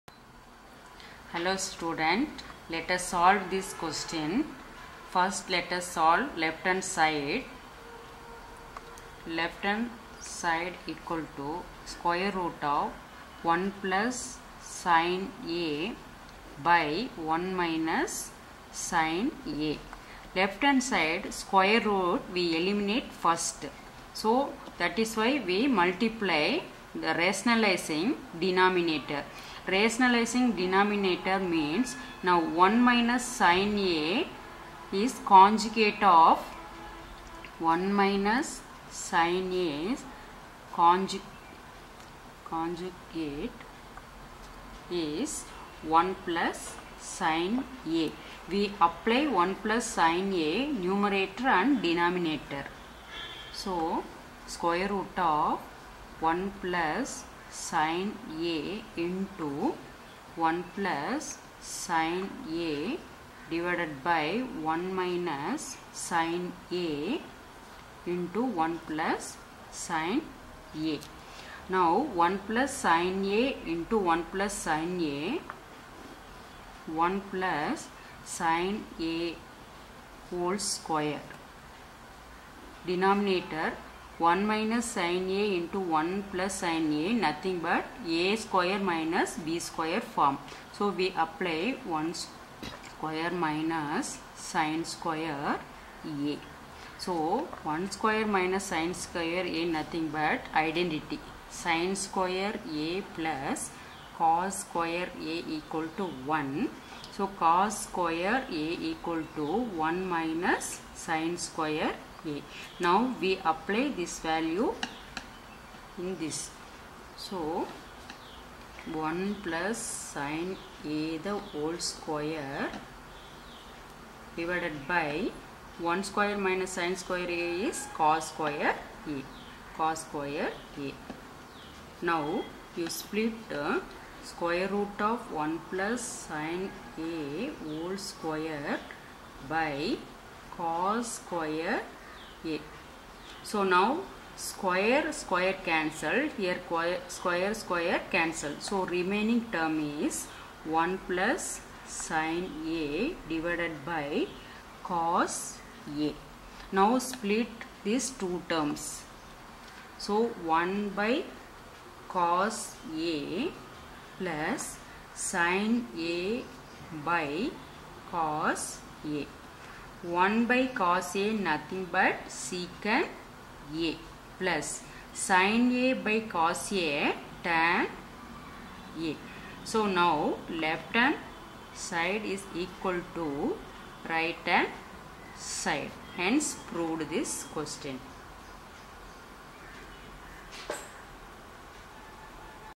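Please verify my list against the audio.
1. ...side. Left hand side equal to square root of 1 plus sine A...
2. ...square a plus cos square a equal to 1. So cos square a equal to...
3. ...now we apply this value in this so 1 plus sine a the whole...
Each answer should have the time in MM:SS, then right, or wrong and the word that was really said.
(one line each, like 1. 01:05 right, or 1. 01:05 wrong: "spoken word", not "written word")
1. 00:06 right
2. 01:42 right
3. 01:52 right.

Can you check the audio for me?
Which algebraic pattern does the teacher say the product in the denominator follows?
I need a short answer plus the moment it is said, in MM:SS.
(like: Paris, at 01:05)
a² − b², at 01:28.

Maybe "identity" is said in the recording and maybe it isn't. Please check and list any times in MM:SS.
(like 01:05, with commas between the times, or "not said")
01:40.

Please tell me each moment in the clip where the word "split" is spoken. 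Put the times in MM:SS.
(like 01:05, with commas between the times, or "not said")
02:13, 02:37.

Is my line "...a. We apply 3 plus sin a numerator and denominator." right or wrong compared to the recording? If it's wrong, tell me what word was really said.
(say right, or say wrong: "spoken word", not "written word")
wrong: "1", not "3".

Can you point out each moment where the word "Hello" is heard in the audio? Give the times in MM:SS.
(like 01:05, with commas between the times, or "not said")
00:01.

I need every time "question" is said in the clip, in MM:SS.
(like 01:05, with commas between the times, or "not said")
00:03, 03:07.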